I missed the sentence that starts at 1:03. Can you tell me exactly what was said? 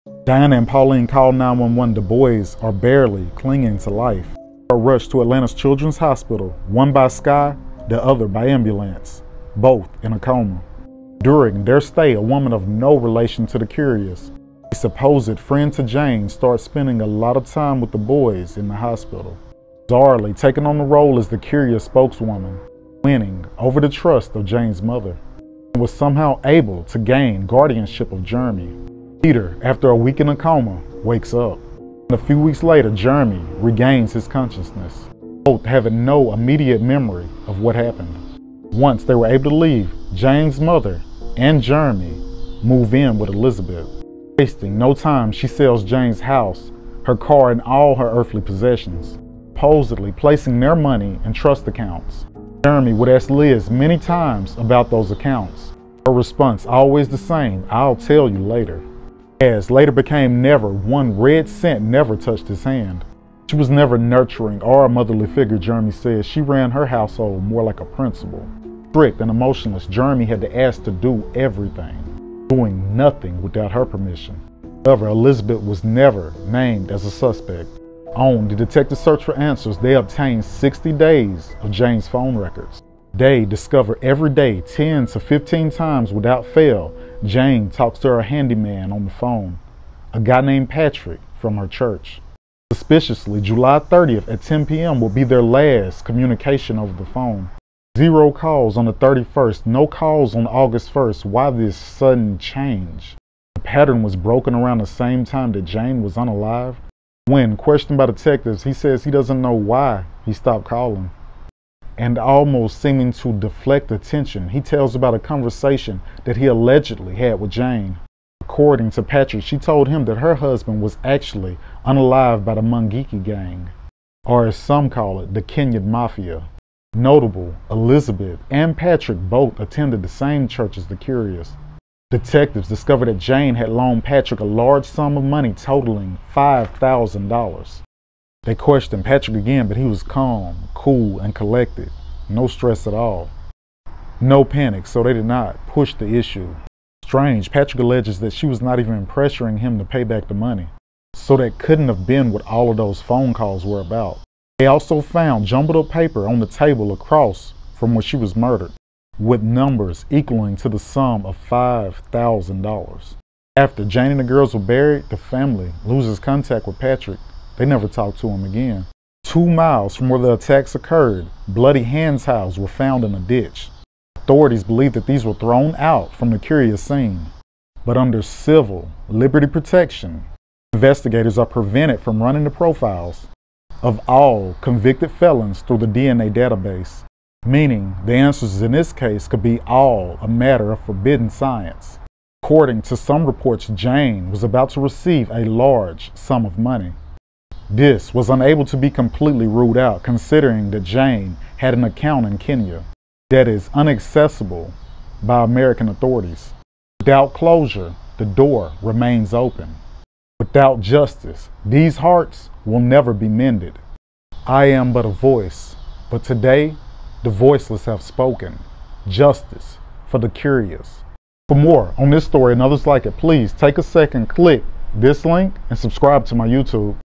She was never nurturing or a motherly figure, Jeremy says.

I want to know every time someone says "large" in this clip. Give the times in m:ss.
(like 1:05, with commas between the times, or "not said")
2:14, 3:15.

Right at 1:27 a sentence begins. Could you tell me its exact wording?
Jane talks to her handyman on the phone, a guy named Patrick from her church.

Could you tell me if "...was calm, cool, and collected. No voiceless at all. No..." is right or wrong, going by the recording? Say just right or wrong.
wrong.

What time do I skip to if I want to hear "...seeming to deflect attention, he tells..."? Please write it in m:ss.
1:52.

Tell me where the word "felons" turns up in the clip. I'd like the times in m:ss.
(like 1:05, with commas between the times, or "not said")
3:05.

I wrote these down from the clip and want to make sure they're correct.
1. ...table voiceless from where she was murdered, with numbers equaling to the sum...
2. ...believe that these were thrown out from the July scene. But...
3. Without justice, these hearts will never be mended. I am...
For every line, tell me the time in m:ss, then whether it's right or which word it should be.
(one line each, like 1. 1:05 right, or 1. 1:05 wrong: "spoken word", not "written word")
1. 2:36 wrong: "across", not "voiceless"
2. 2:54 wrong: "Kurias", not "July"
3. 3:30 right.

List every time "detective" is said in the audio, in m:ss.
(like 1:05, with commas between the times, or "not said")
1:18, 1:48, 2:12.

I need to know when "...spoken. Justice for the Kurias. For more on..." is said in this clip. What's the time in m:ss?
3:38.